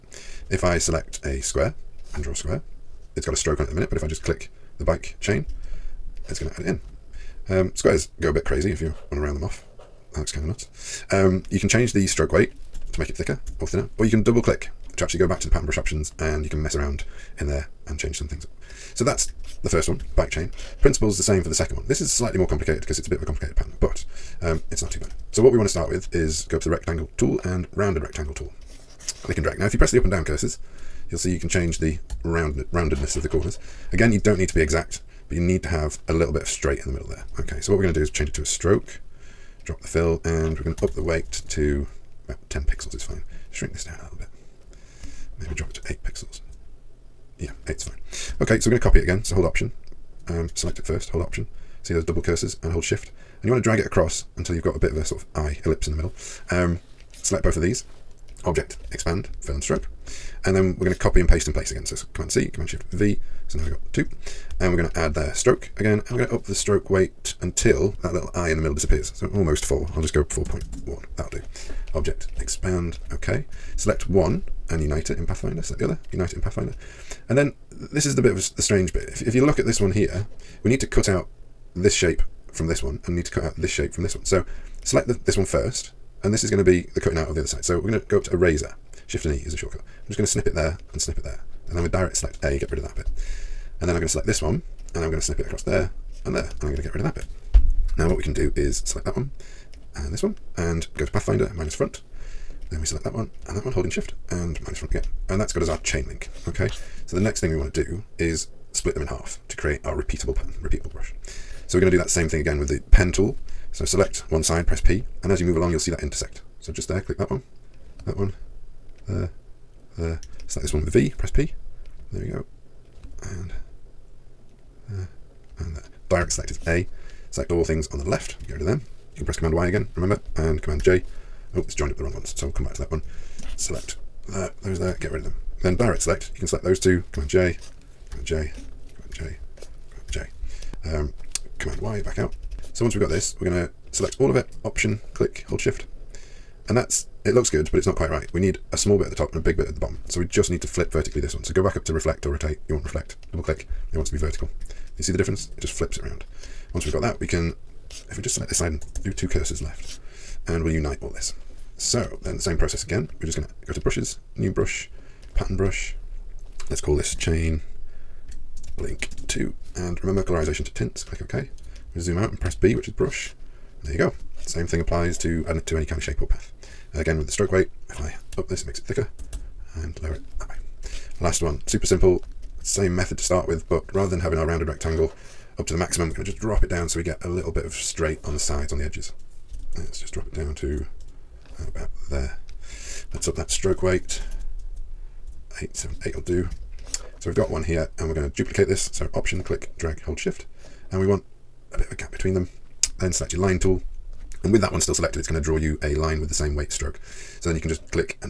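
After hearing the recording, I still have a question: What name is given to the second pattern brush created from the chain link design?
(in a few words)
chain link two.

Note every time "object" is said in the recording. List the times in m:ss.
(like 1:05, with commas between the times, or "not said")
0:58, 1:11.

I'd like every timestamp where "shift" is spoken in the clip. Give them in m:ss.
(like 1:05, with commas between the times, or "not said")
0:52, 1:02, 1:29, 1:43, 2:25, 3:20.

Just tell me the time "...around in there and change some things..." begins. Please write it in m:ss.
0:16.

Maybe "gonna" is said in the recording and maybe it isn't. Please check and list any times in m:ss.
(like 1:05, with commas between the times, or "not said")
1:51, 2:43.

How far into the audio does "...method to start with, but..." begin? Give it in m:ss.
3:02.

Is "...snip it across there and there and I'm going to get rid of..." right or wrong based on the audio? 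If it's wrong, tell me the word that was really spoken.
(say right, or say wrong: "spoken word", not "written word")
right.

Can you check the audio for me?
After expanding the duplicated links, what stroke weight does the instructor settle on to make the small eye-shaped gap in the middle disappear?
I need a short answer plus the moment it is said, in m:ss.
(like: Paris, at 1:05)
4.1, at 1:10.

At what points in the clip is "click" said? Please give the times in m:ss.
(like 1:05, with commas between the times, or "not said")
0:04, 0:14, 0:29, 1:57, 2:25, 2:33, 2:51, 3:19.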